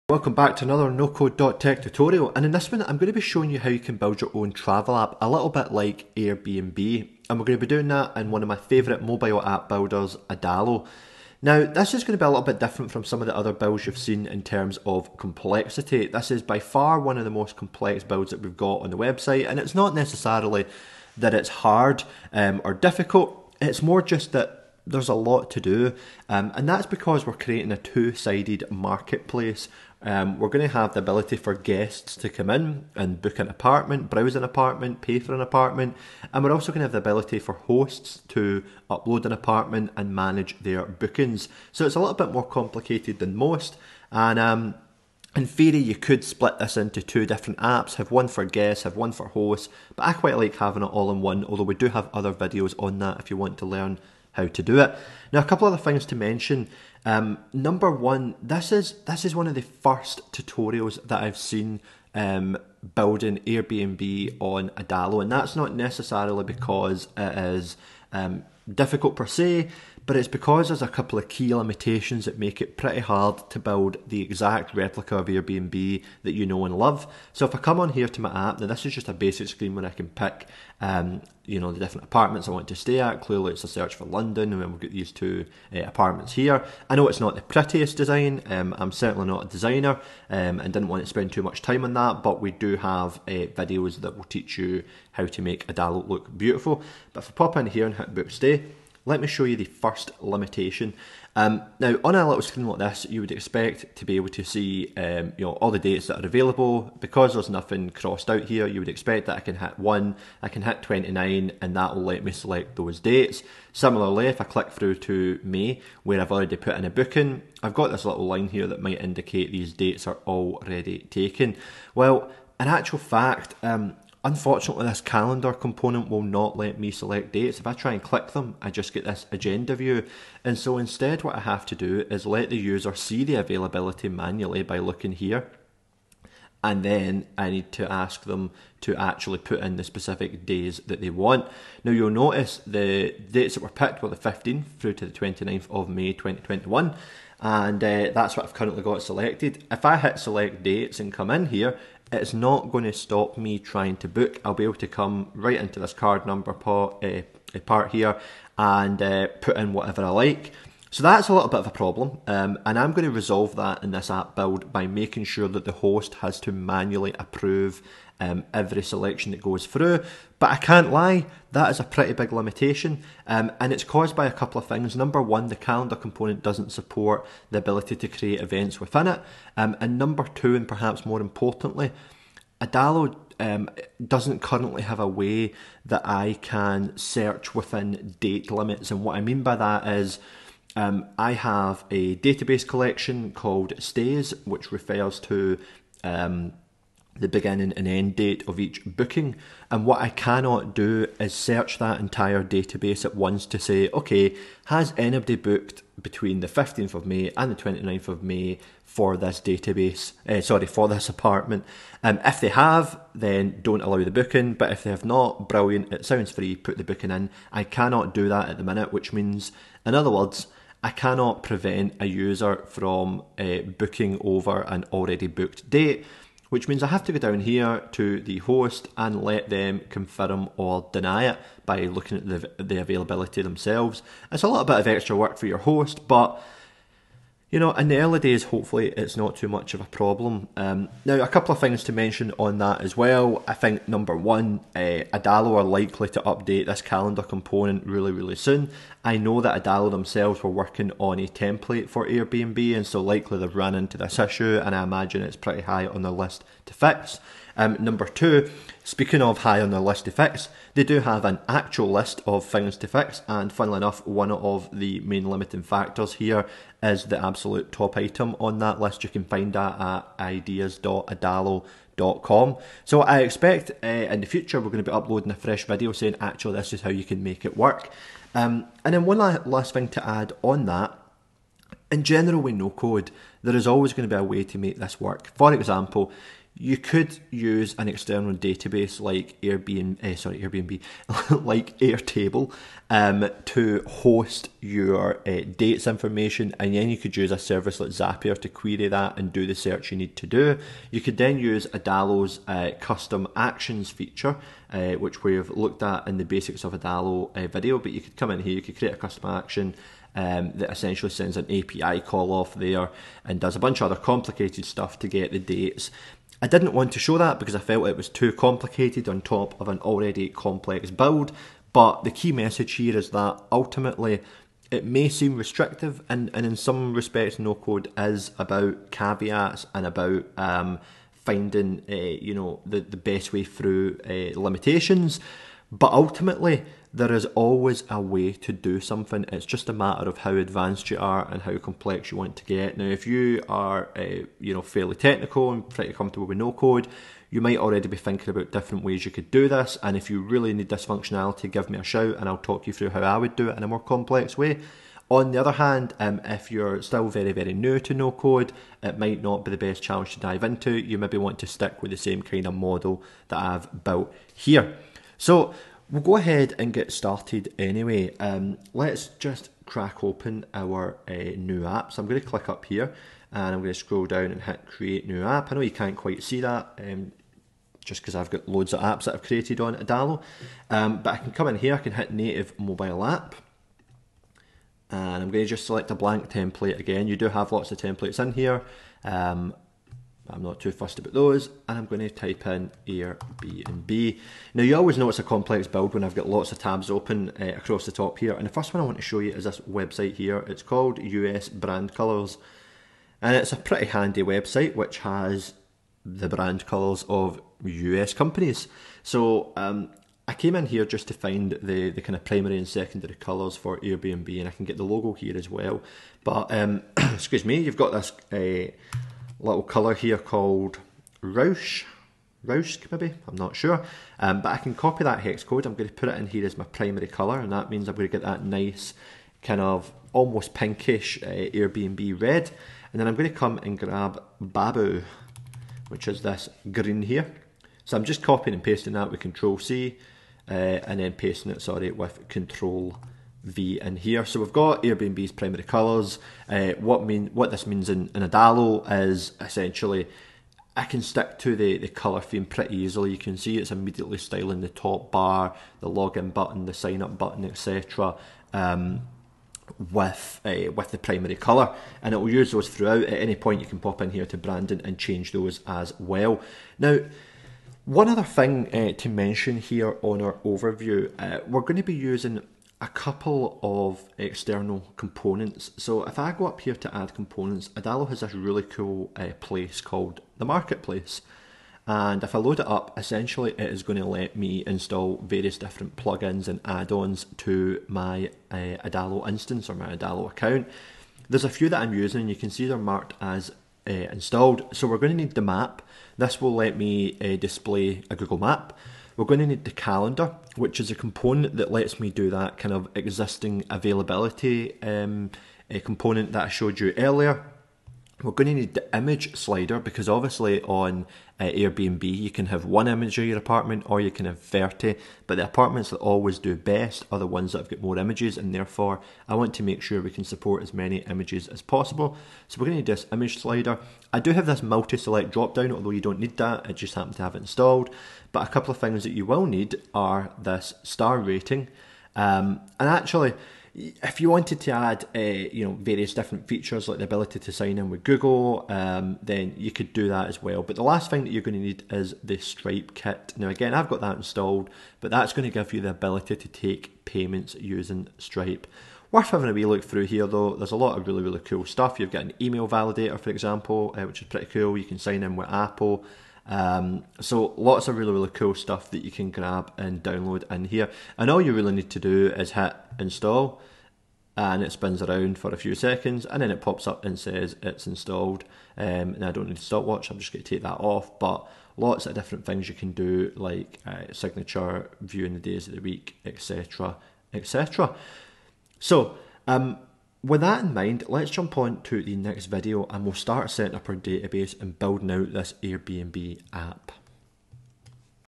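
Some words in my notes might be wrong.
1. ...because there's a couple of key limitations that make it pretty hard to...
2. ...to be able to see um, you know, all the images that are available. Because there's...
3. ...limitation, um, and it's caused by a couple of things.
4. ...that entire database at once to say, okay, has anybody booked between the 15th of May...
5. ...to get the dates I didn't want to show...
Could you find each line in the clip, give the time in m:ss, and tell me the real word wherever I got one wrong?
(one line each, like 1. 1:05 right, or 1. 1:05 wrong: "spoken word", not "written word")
1. 1:10 right
2. 1:43 wrong: "dates", not "images"
3. 2:52 right
4. 3:21 right
5. 5:14 right.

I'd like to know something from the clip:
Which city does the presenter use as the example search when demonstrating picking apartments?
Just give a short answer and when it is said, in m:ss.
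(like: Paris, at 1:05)
London, at 1:24.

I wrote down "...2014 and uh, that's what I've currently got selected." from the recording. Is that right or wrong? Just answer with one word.
wrong.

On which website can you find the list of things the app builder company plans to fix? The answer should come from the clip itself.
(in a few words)
ideas.adalo.com.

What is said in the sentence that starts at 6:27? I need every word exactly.
You do have lots of templates in here.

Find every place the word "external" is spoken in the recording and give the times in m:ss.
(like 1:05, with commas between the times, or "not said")
4:47, 7:54.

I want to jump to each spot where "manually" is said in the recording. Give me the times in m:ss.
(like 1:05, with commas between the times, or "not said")
2:14, 2:46.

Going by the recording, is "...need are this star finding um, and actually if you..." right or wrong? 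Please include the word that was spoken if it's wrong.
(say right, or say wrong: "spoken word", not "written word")
wrong: "rating", not "finding".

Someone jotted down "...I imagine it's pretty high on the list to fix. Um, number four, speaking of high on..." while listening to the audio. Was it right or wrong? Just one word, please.
wrong.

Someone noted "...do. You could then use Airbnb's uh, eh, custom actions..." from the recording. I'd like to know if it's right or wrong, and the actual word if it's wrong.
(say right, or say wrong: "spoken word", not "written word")
wrong: "Adalo", not "Airbnb".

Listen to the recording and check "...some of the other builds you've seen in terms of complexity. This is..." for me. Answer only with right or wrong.
right.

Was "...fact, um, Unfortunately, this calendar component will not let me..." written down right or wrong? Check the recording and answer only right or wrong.
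right.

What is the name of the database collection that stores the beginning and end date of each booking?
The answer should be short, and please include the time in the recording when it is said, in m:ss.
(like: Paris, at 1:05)
Stays, at 3:13.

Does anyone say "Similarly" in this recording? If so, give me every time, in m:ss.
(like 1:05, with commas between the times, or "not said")
1:53.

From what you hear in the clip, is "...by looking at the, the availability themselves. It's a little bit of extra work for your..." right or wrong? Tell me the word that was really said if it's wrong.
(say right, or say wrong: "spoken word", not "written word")
right.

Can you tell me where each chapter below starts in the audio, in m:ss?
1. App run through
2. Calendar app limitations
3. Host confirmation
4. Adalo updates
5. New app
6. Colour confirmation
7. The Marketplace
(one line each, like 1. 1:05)
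1. 1:25
2. 1:43
3. 3:49
4. 4:09
5. 6:15
6. 7:24
7. 8:03.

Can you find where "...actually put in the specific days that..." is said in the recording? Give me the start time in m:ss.
2:18.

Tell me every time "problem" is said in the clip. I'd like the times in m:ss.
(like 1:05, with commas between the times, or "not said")
2:41, 3:59.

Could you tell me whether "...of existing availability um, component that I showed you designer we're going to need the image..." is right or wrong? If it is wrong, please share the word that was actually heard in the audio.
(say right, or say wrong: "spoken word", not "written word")
wrong: "earlier", not "designer".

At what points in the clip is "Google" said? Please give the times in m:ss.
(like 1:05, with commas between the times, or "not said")
8:18, 8:58.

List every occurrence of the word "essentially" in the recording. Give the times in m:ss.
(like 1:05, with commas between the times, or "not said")
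5:10, 7:29, 8:02.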